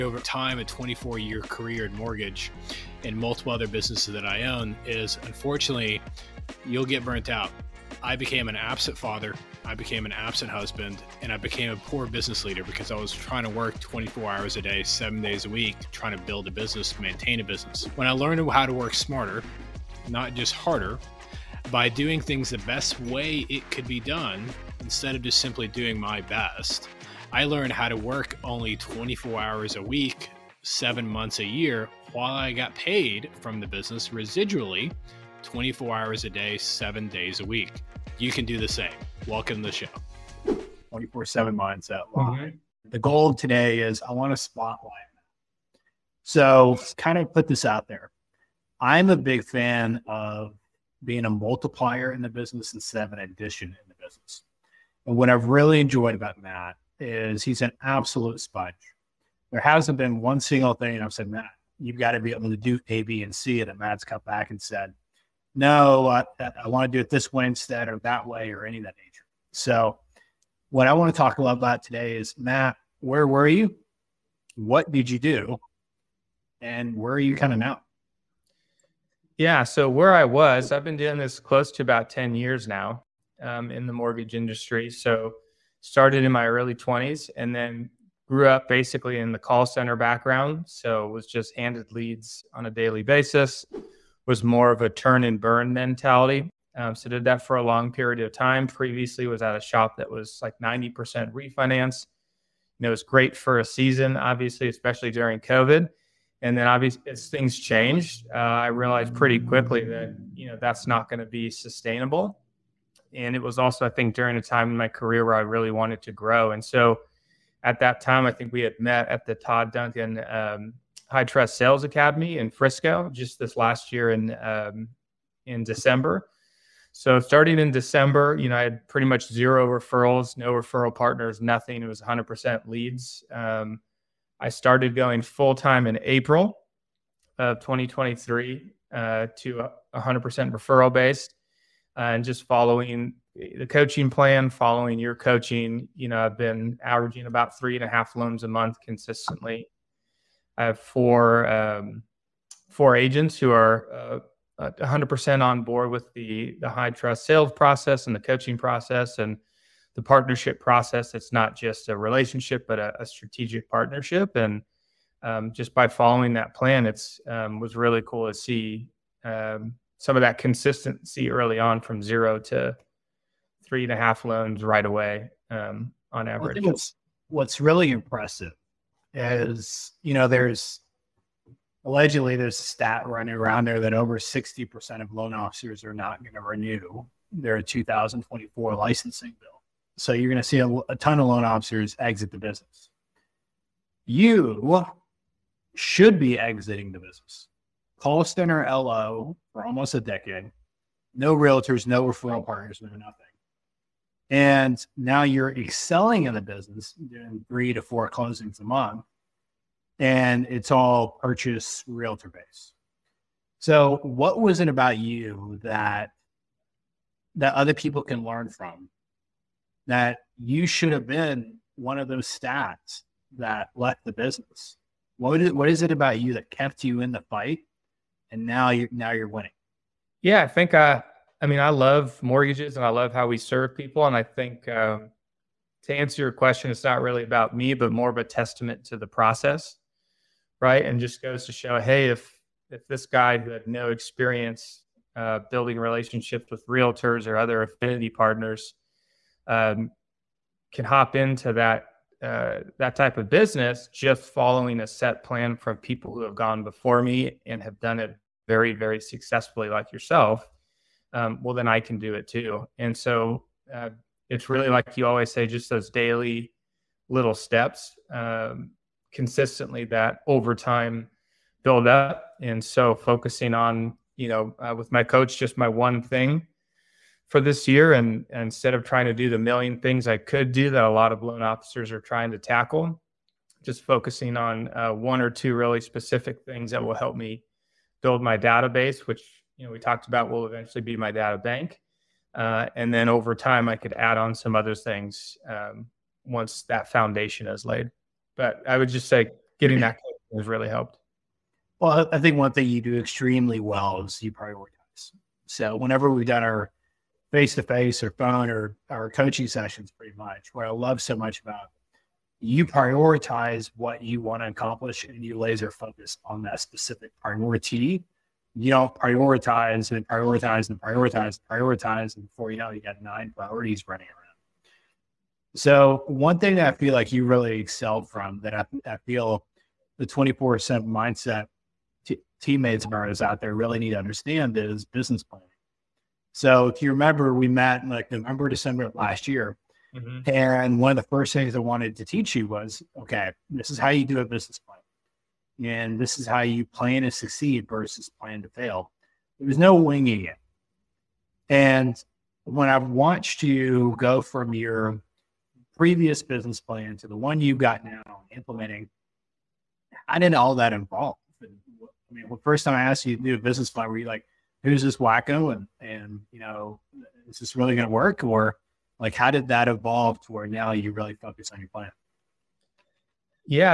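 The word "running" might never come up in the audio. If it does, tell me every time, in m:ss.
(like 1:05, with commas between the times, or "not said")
3:03, 5:23.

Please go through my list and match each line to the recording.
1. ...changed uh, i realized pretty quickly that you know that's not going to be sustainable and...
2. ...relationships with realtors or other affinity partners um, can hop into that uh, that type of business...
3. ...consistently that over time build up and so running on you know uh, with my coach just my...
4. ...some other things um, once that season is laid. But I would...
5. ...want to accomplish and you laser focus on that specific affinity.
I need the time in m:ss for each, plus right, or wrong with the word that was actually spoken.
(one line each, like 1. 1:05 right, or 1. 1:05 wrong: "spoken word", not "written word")
1. 1:47 right
2. 4:05 right
3. 4:29 wrong: "focusing", not "running"
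4. 4:54 wrong: "foundation", not "season"
5. 5:14 wrong: "priority", not "affinity".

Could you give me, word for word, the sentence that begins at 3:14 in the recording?
You should be exiting the business.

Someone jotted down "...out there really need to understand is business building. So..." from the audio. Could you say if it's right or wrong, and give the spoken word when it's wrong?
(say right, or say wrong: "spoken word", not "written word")
wrong: "planning", not "building".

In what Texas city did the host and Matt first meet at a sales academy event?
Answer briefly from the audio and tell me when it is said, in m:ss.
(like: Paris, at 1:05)
Frisco, at 2:02.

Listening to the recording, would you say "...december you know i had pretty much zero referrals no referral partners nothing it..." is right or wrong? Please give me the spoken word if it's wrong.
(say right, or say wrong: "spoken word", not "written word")
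right.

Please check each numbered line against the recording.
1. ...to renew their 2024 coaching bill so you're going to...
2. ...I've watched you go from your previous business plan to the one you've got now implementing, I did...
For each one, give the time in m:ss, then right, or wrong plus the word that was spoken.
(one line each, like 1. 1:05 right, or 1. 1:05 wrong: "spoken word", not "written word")
1. 3:06 wrong: "licensing", not "coaching"
2. 5:52 right.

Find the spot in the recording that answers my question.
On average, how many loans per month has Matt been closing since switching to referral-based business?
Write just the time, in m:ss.
2:27.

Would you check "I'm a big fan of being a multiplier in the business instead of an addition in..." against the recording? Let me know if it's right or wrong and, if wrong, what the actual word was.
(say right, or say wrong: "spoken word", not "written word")
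right.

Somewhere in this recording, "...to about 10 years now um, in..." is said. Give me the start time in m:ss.
1:21.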